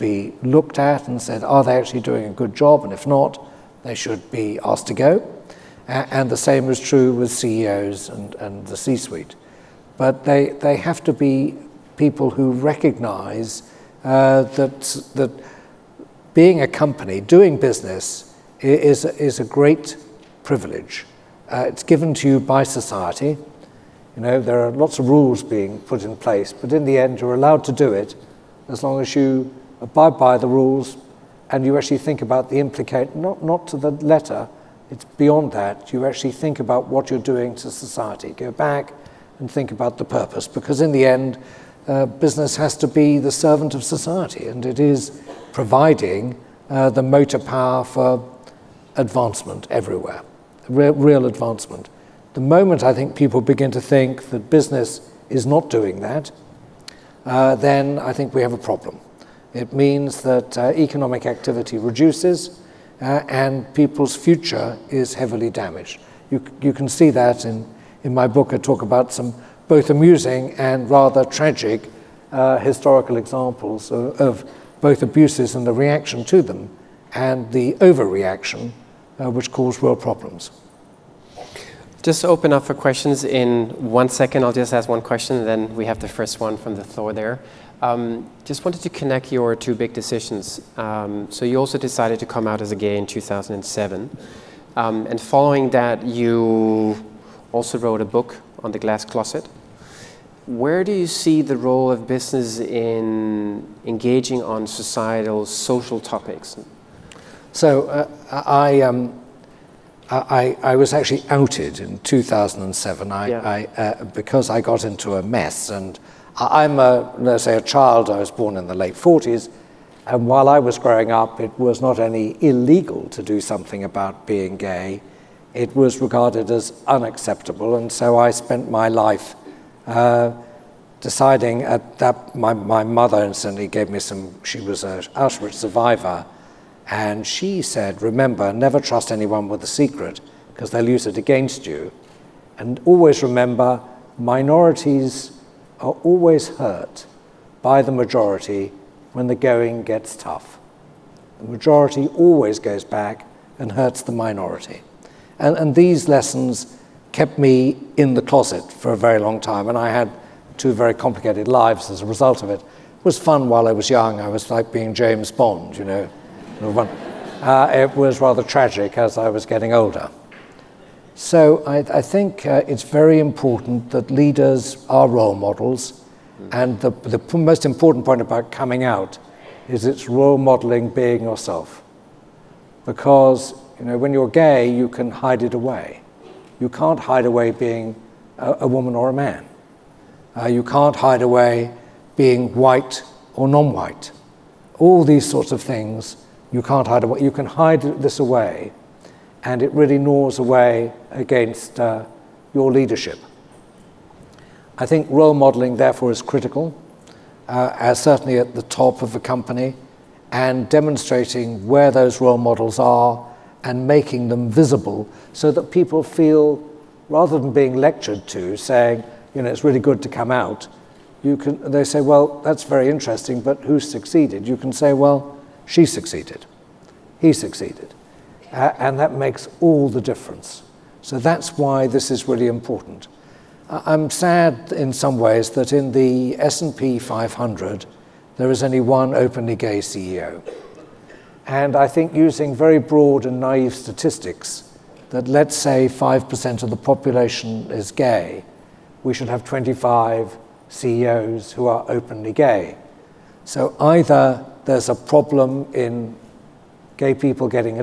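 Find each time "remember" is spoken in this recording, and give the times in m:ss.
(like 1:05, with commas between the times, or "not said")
2:18, 2:23.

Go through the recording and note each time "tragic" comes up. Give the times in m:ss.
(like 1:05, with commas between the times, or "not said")
1:11, 2:48.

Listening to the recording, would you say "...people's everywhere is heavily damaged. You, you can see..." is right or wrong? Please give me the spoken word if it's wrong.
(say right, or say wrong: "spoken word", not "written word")
wrong: "future", not "everywhere".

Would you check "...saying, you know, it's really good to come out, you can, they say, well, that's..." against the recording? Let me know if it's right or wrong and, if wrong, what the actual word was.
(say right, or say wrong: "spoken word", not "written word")
right.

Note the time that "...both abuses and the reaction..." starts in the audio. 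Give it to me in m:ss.
1:14.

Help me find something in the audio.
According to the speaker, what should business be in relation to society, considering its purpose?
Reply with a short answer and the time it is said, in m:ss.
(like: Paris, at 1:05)
The servant of society, at 0:43.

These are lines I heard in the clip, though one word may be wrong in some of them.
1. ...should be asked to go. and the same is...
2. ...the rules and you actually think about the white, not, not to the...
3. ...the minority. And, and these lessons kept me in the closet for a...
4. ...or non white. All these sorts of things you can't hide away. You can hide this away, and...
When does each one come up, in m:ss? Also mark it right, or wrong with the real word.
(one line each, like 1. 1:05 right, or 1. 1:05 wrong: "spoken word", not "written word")
1. 0:03 right
2. 0:30 wrong: "implicate", not "white"
3. 2:34 right
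4. 3:13 right.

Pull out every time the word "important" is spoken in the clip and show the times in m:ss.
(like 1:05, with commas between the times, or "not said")
2:53, 2:57, 3:52.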